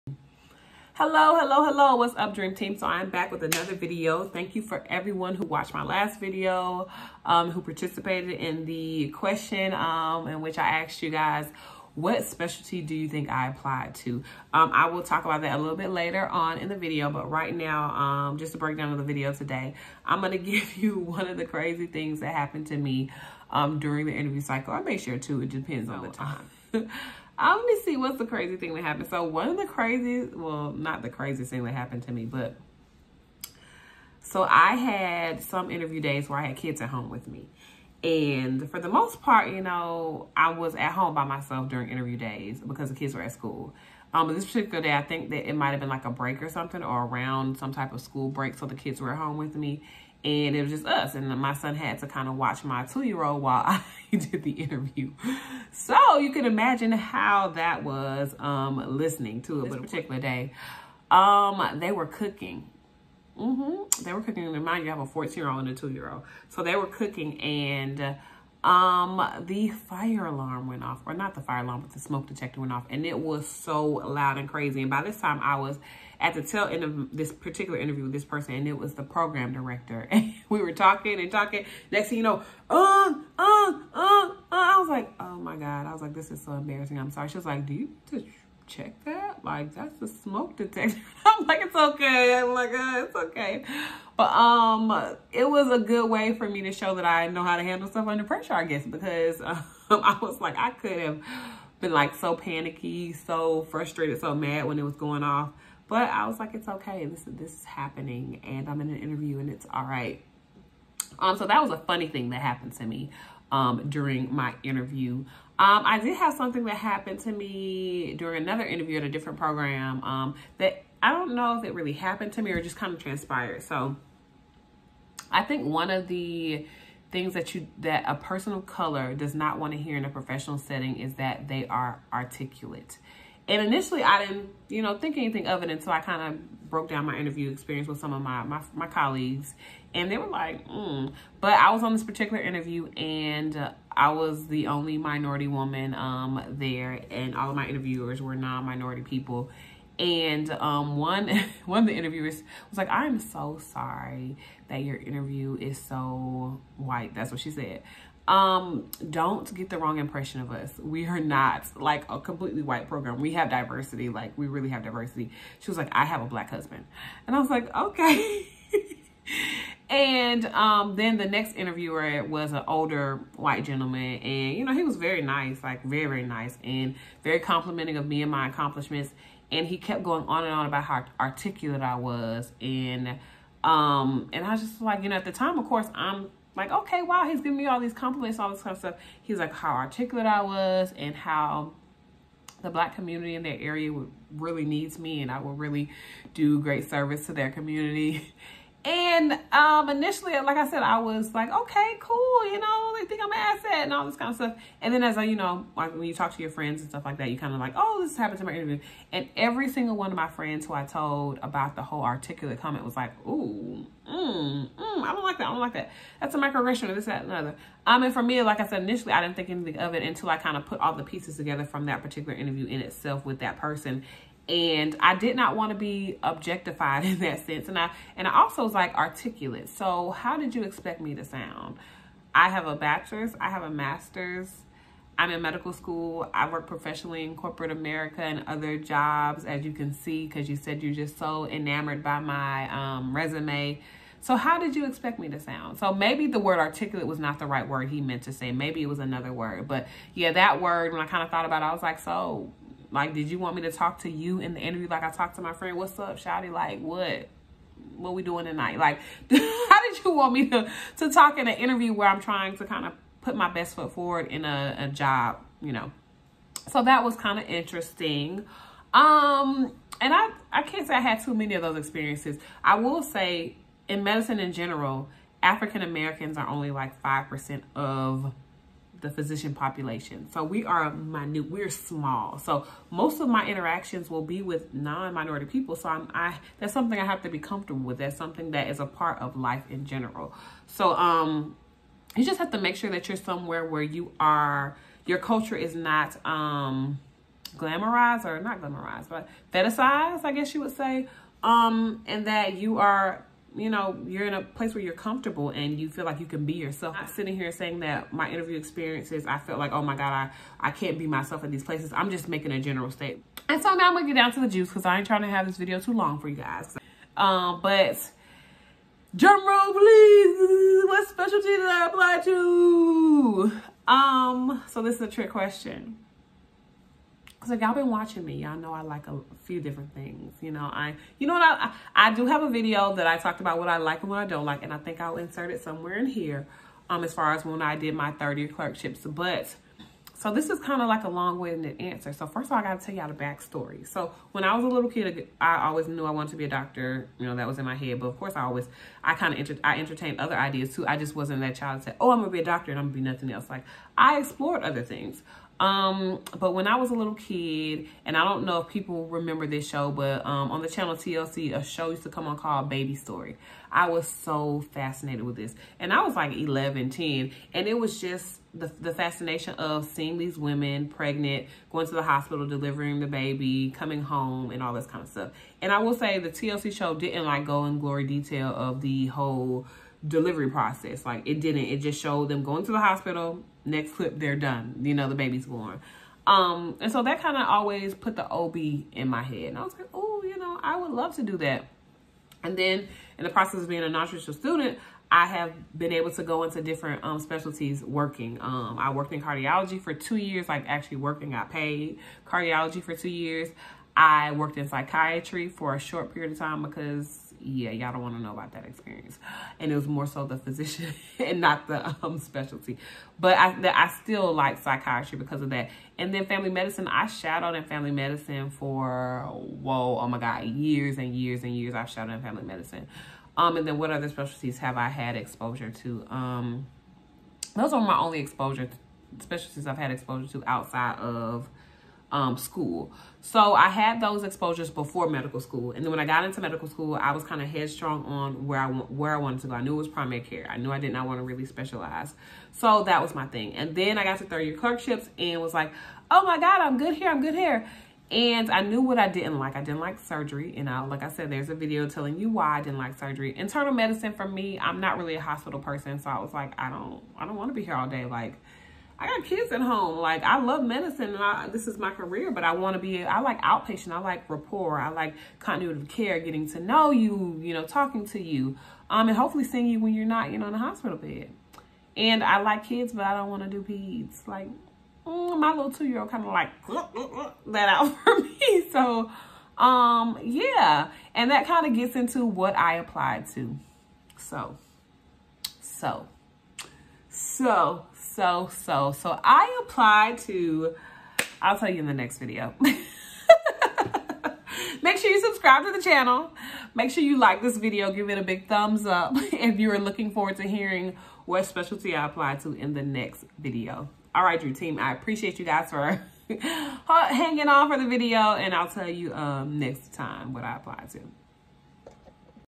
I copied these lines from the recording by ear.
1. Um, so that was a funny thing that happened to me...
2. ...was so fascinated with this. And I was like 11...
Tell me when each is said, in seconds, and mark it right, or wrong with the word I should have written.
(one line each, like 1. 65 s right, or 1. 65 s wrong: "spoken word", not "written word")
1. 111 s right
2. 363 s right.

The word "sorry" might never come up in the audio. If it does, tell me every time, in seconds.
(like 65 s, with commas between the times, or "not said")
87 s, 153 s.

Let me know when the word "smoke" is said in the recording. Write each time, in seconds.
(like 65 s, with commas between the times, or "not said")
71 s, 90 s.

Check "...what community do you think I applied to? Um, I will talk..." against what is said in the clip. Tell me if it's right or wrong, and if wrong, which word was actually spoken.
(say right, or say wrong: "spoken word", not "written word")
wrong: "specialty", not "community".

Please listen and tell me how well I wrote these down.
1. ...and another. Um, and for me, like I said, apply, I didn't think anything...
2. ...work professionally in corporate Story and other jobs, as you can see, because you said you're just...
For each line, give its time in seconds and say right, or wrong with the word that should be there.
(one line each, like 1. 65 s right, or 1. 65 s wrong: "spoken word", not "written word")
1. 217 s wrong: "initially", not "apply"
2. 236 s wrong: "America", not "Story".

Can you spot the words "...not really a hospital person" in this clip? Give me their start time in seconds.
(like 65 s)
454 s.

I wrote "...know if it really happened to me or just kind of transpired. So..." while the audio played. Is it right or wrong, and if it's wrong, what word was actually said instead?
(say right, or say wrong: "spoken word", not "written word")
right.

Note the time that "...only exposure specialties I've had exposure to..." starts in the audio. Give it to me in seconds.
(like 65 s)
427 s.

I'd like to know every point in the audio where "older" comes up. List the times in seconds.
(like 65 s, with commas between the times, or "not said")
172 s.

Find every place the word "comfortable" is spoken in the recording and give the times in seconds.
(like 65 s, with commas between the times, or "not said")
287 s, 304 s.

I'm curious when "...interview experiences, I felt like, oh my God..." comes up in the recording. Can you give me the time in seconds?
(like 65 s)
308 s.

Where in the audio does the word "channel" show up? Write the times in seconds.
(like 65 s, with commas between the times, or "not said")
360 s, 495 s.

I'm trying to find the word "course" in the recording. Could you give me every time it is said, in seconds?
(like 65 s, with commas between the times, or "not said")
185 s, 348 s.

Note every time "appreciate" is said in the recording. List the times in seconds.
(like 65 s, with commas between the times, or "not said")
504 s.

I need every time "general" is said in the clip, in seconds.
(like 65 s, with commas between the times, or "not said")
274 s, 289 s, 312 s.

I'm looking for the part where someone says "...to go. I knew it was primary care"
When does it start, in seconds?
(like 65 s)
439 s.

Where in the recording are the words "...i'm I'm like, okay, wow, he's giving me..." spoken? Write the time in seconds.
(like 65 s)
185 s.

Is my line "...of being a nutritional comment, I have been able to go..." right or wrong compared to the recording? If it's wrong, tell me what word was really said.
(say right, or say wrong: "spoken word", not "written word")
wrong: "student", not "comment".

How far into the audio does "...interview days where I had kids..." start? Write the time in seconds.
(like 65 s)
35 s.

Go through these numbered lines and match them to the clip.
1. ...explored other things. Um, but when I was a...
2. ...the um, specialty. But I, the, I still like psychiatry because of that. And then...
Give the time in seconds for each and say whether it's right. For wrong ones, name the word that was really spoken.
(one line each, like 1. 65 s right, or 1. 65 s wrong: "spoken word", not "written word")
1. 354 s right
2. 411 s right.